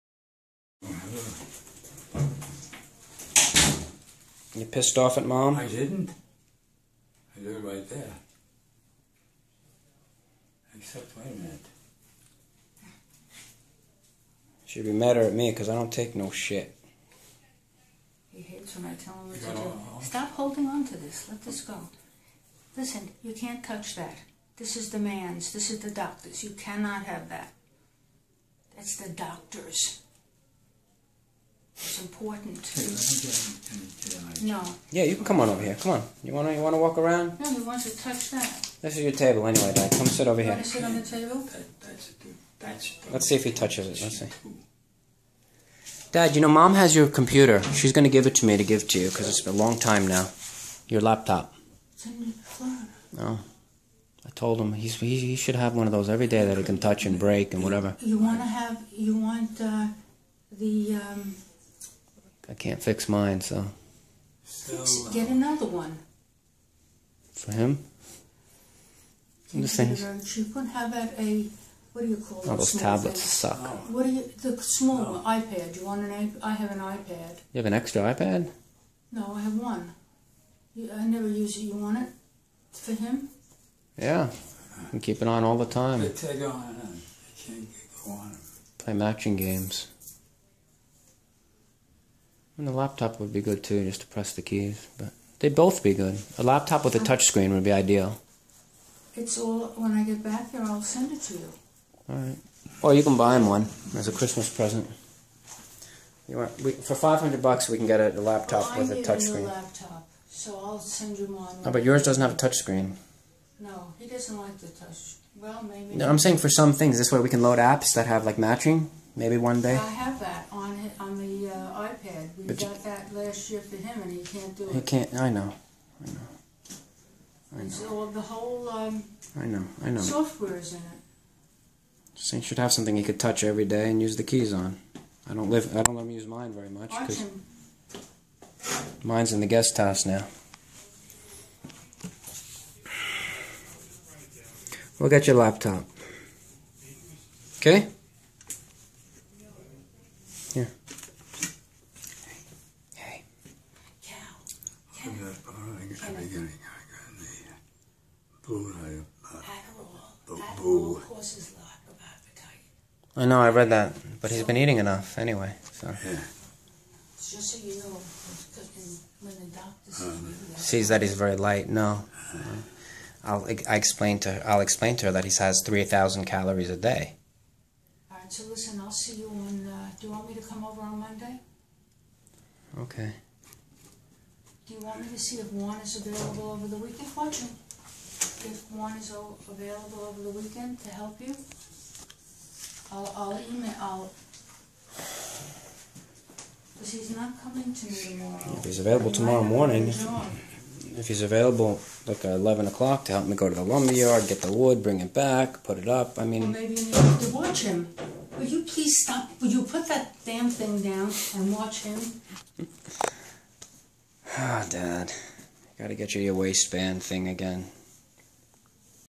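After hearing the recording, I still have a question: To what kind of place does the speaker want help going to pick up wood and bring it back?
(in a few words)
The lumberyard.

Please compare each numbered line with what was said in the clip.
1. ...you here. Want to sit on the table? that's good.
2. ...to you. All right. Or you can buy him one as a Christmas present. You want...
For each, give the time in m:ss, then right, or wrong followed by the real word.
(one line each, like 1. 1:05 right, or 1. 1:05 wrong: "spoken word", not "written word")
1. 0:40 right
2. 1:41 right.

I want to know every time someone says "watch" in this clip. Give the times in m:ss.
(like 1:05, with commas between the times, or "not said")
3:07, 3:27, 3:31.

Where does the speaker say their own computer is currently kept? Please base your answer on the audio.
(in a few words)
The guest house.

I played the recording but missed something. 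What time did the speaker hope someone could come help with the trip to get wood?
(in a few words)
11 o'clock.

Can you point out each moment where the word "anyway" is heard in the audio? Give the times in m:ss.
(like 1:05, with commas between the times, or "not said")
0:39, 2:45.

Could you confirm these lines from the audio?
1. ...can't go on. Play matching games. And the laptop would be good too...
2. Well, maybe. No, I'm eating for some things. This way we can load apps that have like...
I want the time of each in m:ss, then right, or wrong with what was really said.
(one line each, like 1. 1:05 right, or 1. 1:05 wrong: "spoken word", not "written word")
1. 1:27 right
2. 1:55 wrong: "saying", not "eating".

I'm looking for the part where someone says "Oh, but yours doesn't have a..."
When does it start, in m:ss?
1:51.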